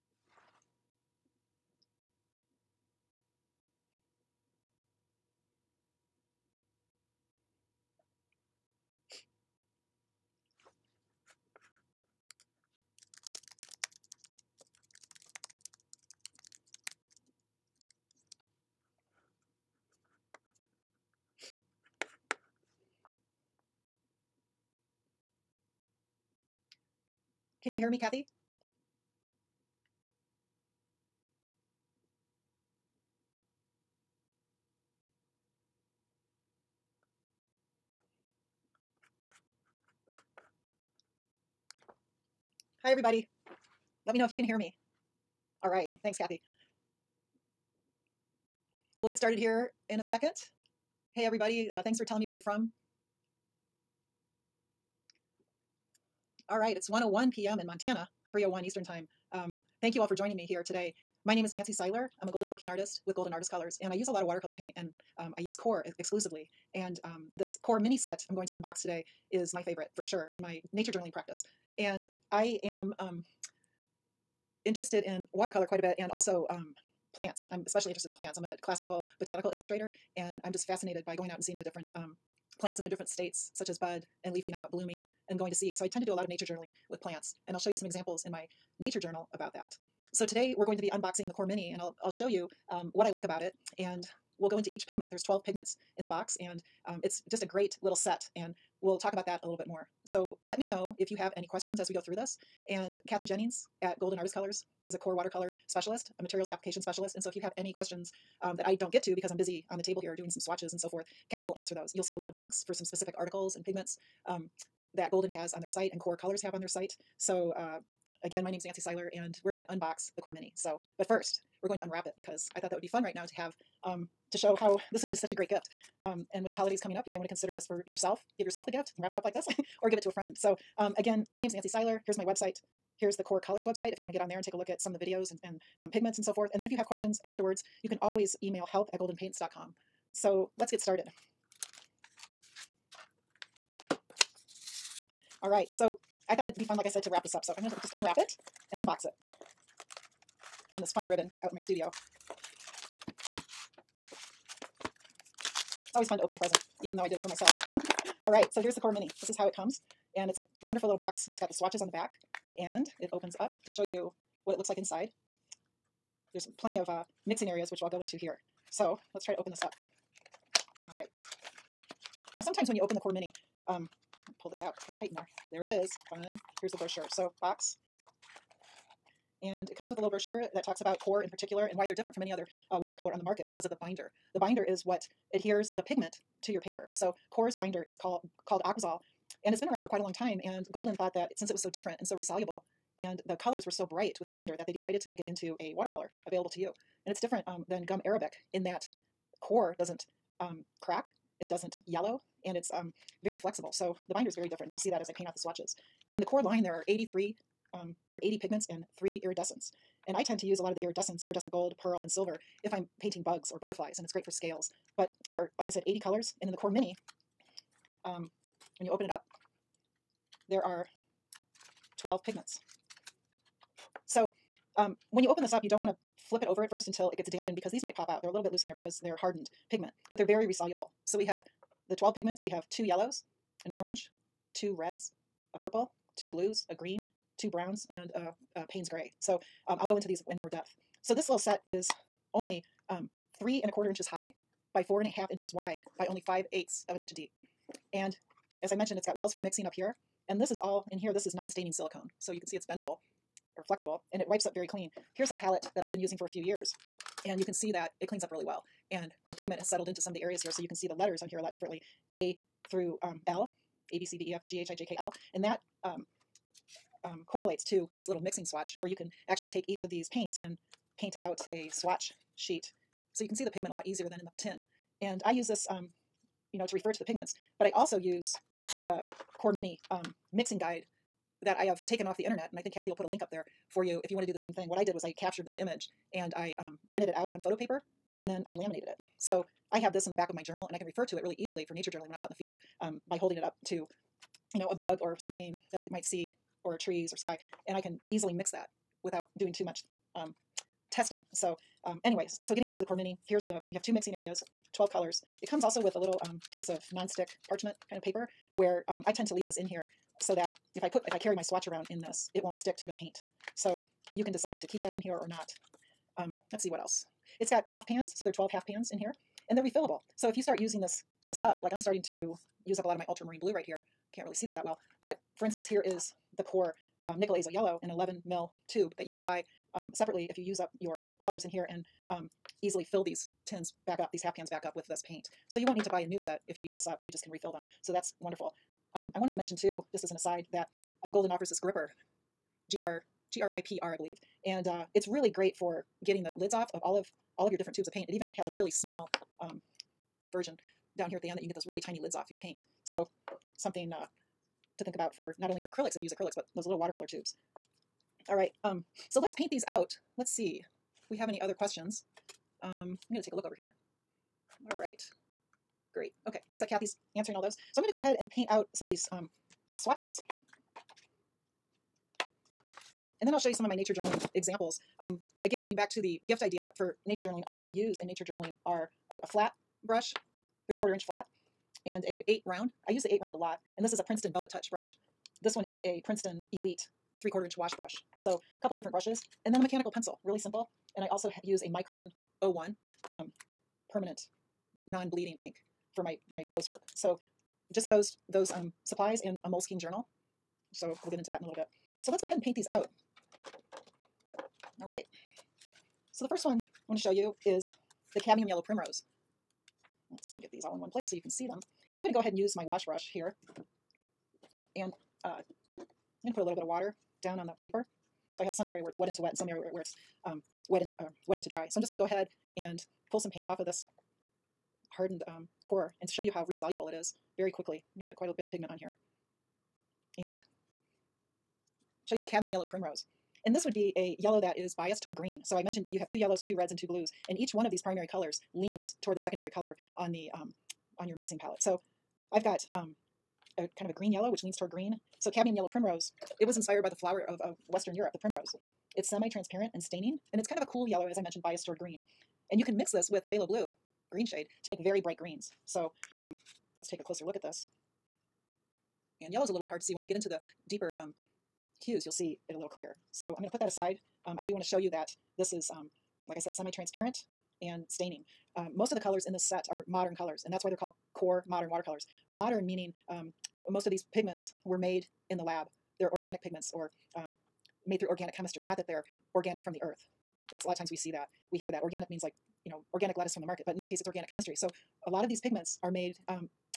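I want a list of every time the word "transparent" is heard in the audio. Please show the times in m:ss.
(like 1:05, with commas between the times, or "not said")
7:29, 7:46.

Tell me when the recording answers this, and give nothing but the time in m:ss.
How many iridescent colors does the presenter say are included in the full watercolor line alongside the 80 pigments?
3:28.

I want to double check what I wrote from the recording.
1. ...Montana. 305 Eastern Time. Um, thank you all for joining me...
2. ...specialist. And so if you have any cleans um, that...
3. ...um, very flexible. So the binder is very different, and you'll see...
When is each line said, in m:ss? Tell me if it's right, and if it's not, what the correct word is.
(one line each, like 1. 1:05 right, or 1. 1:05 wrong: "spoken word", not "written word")
1. 0:57 wrong: "301", not "305"
2. 1:46 wrong: "questions", not "cleans"
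3. 3:22 right.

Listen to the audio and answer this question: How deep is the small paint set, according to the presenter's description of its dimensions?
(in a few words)
5/8 of an inch.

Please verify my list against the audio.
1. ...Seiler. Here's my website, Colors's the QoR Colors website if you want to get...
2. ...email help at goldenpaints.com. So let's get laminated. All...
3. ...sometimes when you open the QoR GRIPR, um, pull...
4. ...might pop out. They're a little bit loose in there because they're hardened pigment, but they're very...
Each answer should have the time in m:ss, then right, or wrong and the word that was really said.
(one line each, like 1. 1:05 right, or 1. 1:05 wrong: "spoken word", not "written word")
1. 2:11 wrong: "Here", not "Colors"
2. 2:18 wrong: "started", not "laminated"
3. 2:52 wrong: "Mini", not "GRIPR"
4. 3:47 right.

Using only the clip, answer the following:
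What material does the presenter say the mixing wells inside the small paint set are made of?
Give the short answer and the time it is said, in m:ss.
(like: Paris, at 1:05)
non-staining silicone, at 4:11.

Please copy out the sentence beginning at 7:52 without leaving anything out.
Modern meaning um, most of these pigments were made in the lab.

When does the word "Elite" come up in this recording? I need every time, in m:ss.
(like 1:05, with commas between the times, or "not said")
6:26.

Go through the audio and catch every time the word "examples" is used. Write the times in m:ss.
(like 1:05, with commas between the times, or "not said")
1:27, 6:14.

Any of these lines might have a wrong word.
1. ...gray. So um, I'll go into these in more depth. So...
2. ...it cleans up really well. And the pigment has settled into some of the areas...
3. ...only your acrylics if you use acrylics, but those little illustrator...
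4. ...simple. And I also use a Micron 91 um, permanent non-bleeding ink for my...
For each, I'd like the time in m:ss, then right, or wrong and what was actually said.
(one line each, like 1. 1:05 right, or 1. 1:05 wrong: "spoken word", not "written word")
1. 3:58 right
2. 4:18 right
3. 5:55 wrong: "watercolor", not "illustrator"
4. 6:30 wrong: "01", not "91".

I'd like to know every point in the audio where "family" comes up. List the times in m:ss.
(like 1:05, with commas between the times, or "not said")
not said.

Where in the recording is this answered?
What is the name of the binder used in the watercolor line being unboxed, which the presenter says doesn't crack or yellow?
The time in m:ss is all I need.
3:08.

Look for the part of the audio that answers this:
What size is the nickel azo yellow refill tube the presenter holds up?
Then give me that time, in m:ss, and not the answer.
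5:27.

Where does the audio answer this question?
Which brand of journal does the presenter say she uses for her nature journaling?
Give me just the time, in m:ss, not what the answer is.
6:39.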